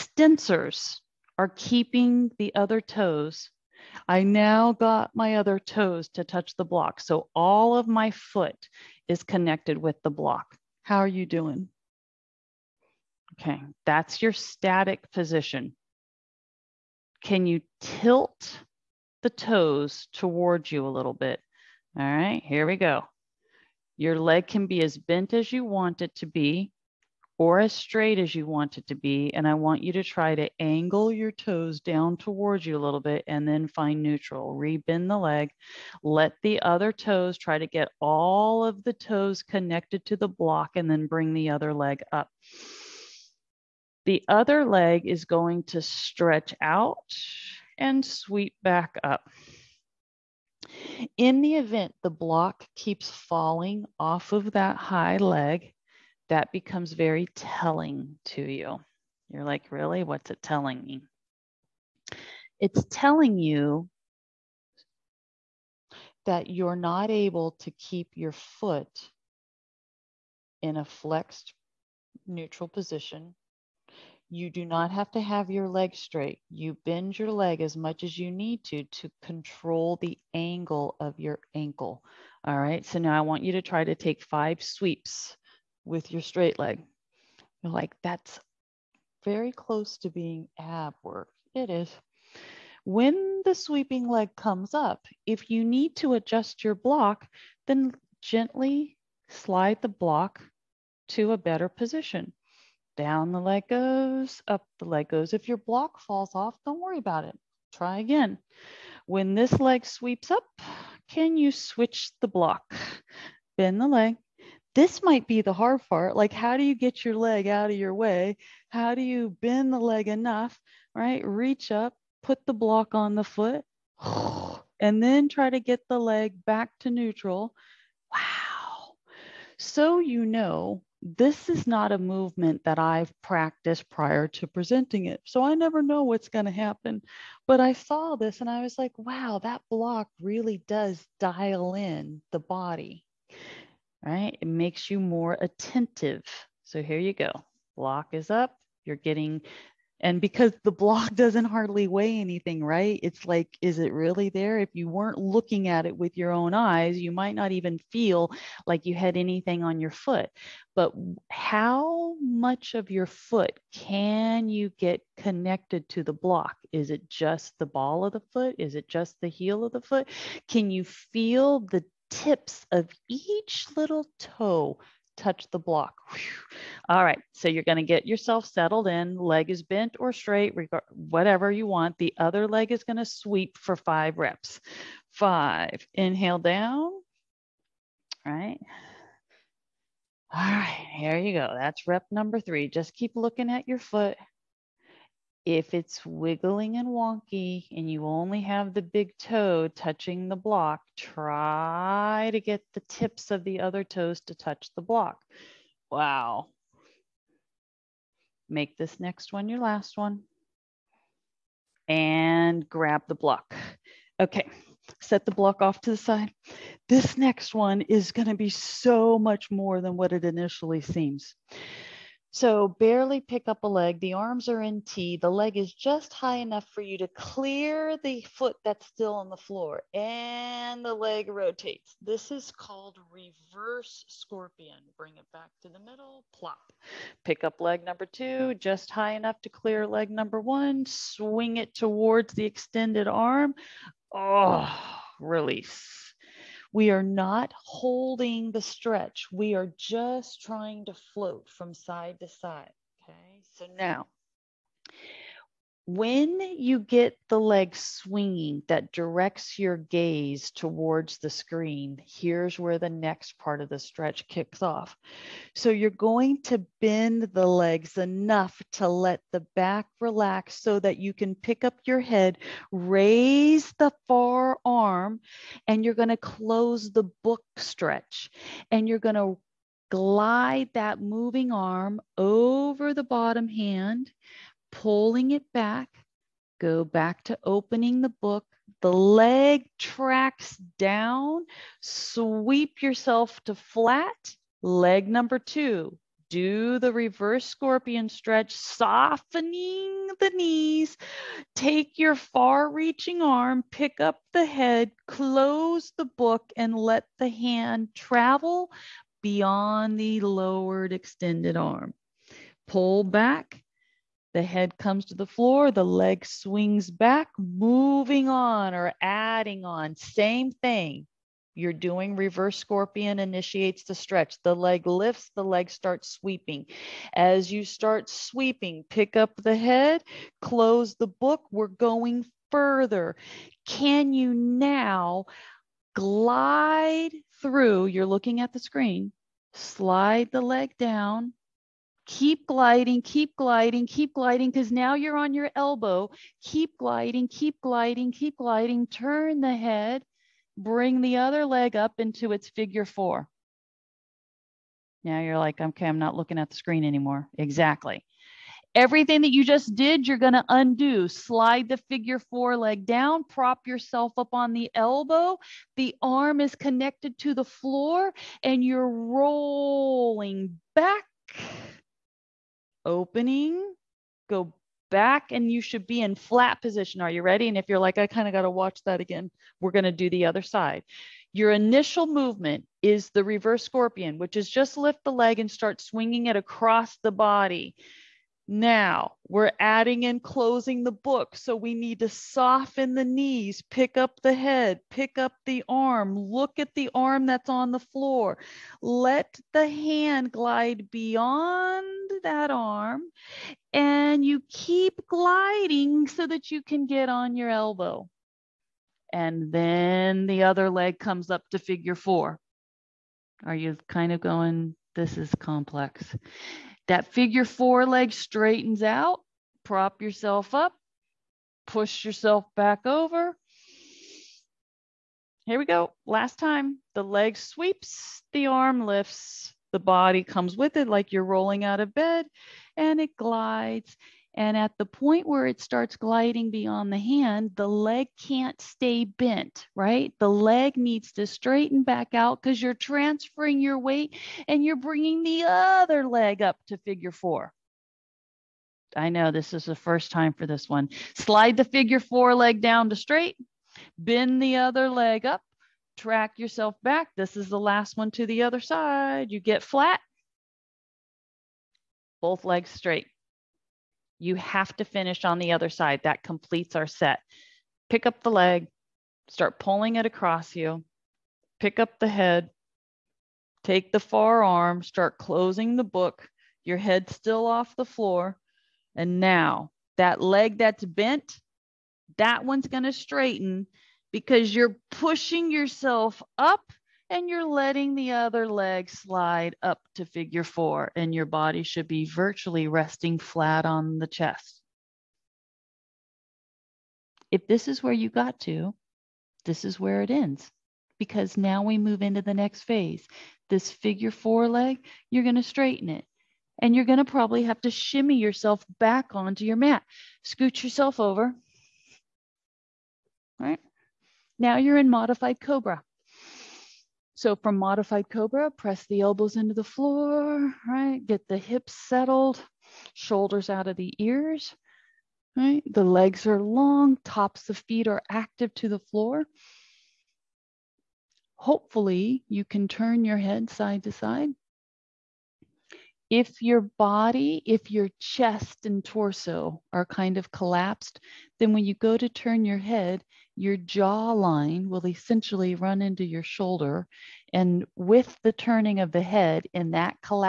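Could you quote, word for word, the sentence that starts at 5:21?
You're doing reverse scorpion initiates the stretch.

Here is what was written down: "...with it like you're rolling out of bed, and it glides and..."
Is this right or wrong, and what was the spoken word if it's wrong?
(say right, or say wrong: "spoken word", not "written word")
right.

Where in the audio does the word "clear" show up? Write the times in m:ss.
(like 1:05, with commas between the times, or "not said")
3:47, 3:59.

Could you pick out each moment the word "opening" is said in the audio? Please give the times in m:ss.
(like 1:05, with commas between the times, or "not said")
4:47, 6:12.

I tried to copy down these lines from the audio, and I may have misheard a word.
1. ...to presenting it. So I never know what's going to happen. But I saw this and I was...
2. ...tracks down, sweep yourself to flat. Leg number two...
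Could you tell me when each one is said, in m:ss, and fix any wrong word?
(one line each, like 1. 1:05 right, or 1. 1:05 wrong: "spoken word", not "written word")
1. 2:14 right
2. 4:49 right.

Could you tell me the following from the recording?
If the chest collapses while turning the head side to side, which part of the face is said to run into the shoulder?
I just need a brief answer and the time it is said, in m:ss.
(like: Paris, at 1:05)
Jawline, at 9:03.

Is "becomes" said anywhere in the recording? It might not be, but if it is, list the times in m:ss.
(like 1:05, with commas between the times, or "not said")
0:56.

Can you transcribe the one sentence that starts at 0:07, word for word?
So all of my foot is connected with the block.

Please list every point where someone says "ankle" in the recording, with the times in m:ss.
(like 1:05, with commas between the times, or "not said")
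1:21.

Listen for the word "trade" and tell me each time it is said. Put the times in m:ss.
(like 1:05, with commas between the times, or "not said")
not said.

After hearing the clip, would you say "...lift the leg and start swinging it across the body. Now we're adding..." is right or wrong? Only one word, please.
right.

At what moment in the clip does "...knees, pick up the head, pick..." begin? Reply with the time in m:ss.
6:33.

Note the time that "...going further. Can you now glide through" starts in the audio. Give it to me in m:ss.
5:31.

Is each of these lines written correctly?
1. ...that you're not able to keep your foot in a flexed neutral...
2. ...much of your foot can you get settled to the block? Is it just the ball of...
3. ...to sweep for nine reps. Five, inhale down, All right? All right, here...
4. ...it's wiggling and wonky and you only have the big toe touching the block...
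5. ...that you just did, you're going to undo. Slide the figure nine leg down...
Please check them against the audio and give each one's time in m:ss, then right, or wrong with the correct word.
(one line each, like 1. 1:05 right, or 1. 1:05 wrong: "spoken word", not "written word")
1. 1:06 right
2. 2:42 wrong: "connected", not "settled"
3. 3:02 wrong: "five", not "nine"
4. 3:15 right
5. 5:59 wrong: "four", not "nine".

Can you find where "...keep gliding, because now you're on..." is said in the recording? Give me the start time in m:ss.
5:43.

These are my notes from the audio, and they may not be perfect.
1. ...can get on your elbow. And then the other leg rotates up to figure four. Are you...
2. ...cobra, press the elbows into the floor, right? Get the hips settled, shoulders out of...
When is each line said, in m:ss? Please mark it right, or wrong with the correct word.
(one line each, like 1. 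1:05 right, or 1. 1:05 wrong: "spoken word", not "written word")
1. 6:46 wrong: "comes", not "rotates"
2. 8:38 right.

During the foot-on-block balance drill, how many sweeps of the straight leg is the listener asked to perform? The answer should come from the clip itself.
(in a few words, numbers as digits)
5.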